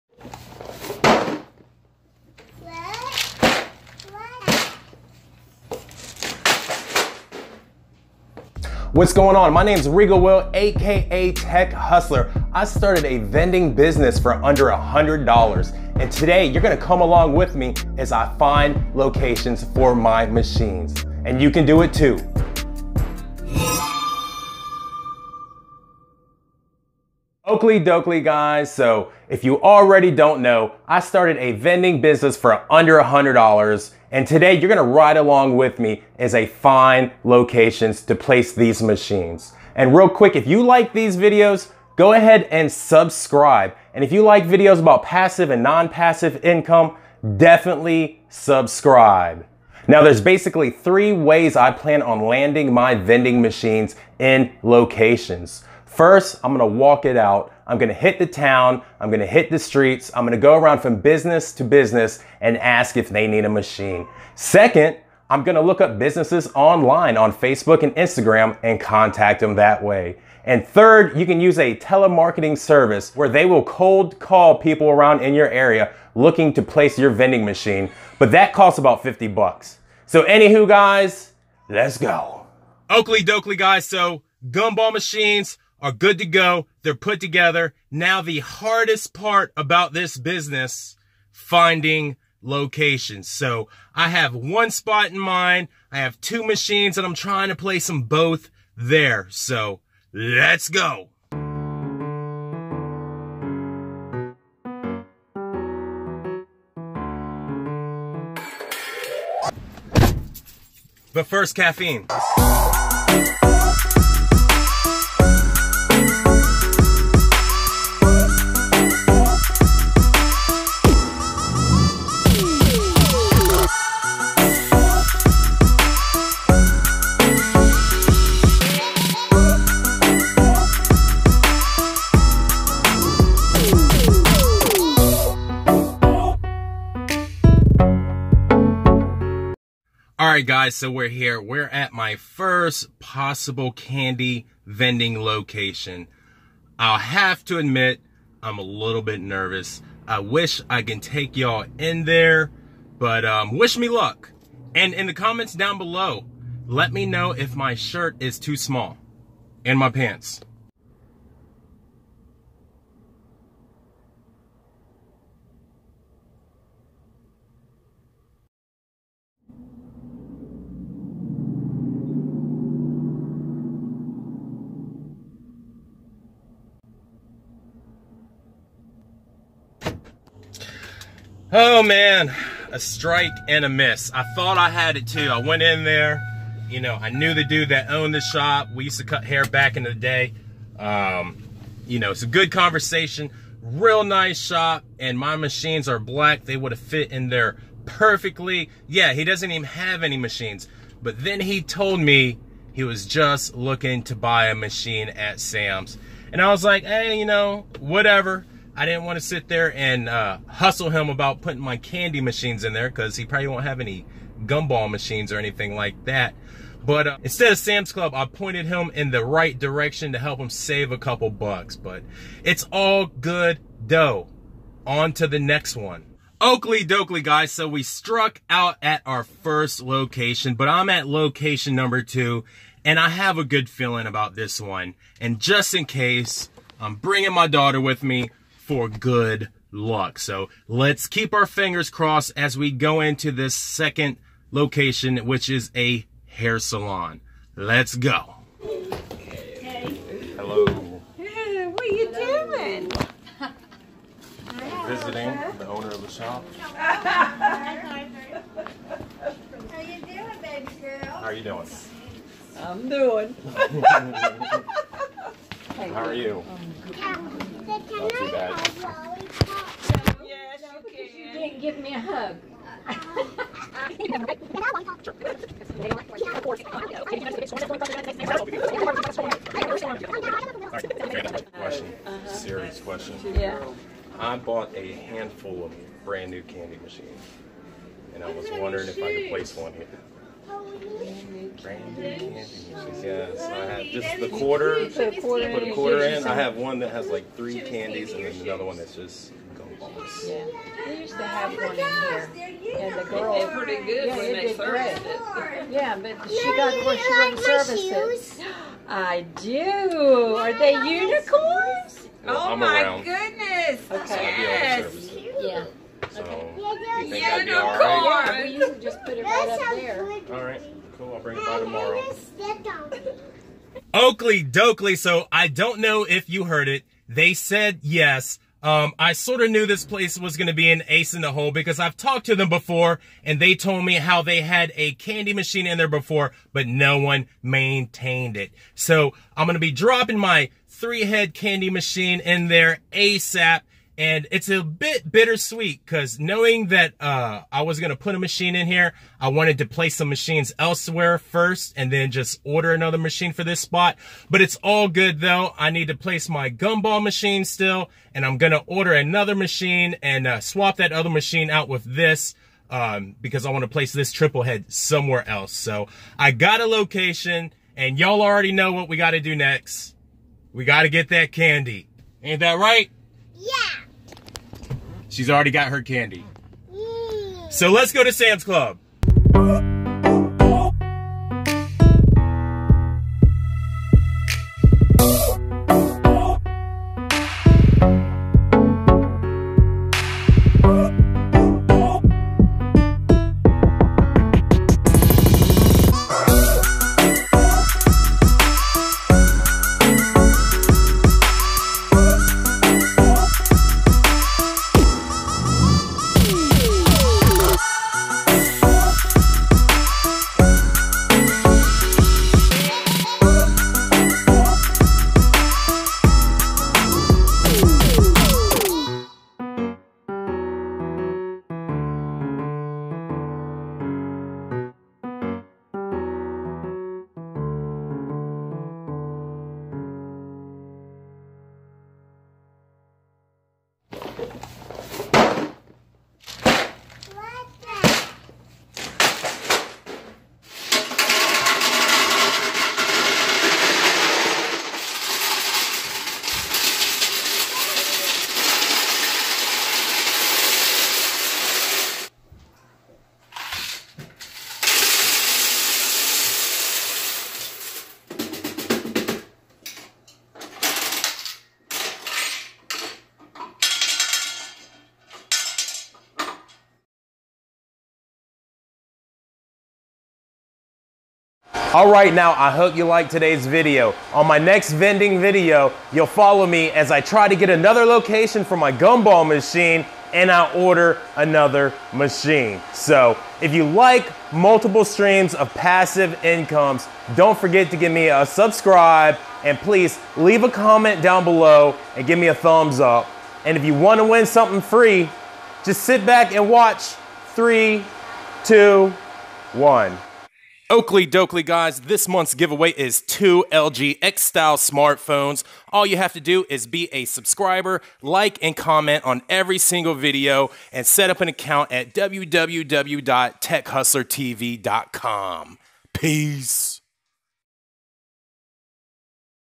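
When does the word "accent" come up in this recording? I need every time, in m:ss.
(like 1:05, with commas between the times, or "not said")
not said.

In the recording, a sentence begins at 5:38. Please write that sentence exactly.
So I'm going to be dropping my three head candy machine in there ASAP.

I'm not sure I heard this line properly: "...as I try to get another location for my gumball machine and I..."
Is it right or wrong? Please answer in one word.
right.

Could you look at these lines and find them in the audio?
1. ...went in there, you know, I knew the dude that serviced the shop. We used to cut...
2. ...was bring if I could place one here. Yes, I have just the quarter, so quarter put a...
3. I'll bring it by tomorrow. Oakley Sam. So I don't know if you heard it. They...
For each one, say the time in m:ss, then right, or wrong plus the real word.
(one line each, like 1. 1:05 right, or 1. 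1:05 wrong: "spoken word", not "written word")
1. 3:05 wrong: "owned", not "serviced"
2. 4:48 wrong: "wondering", not "bring"
3. 5:21 wrong: "Dokley", not "Sam".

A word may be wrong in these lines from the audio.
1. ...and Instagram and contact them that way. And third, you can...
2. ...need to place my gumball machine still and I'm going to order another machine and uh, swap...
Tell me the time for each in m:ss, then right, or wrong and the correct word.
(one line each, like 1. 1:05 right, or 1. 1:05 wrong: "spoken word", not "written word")
1. 1:07 right
2. 5:55 right.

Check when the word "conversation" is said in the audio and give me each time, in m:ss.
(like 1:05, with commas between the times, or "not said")
3:12.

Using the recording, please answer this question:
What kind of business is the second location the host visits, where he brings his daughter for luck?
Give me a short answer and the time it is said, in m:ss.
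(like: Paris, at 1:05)
Hair salon, at 4:06.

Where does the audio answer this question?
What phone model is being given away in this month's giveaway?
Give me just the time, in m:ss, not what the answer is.
8:23.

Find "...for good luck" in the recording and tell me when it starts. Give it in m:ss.
3:58.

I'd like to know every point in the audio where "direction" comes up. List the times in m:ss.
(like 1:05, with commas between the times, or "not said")
3:39.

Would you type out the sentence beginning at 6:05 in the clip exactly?
So I got a location and y'all already know what we got to do next.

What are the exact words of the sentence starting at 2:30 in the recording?
I wish I can take y'all in there, but um, wish me luck.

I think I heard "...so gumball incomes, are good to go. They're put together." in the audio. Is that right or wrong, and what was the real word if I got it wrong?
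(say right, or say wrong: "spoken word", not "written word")
wrong: "machines", not "incomes".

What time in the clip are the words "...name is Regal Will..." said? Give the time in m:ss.
0:09.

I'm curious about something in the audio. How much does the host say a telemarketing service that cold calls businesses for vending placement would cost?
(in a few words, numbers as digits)
$50.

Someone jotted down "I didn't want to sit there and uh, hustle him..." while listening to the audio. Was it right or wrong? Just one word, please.
right.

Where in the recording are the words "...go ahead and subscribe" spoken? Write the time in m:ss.
0:41.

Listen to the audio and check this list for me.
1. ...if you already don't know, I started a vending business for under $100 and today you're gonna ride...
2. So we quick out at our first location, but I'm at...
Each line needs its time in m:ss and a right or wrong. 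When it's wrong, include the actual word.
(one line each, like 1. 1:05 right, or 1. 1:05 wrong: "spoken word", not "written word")
1. 0:29 right
2. 3:47 wrong: "struck", not "quick".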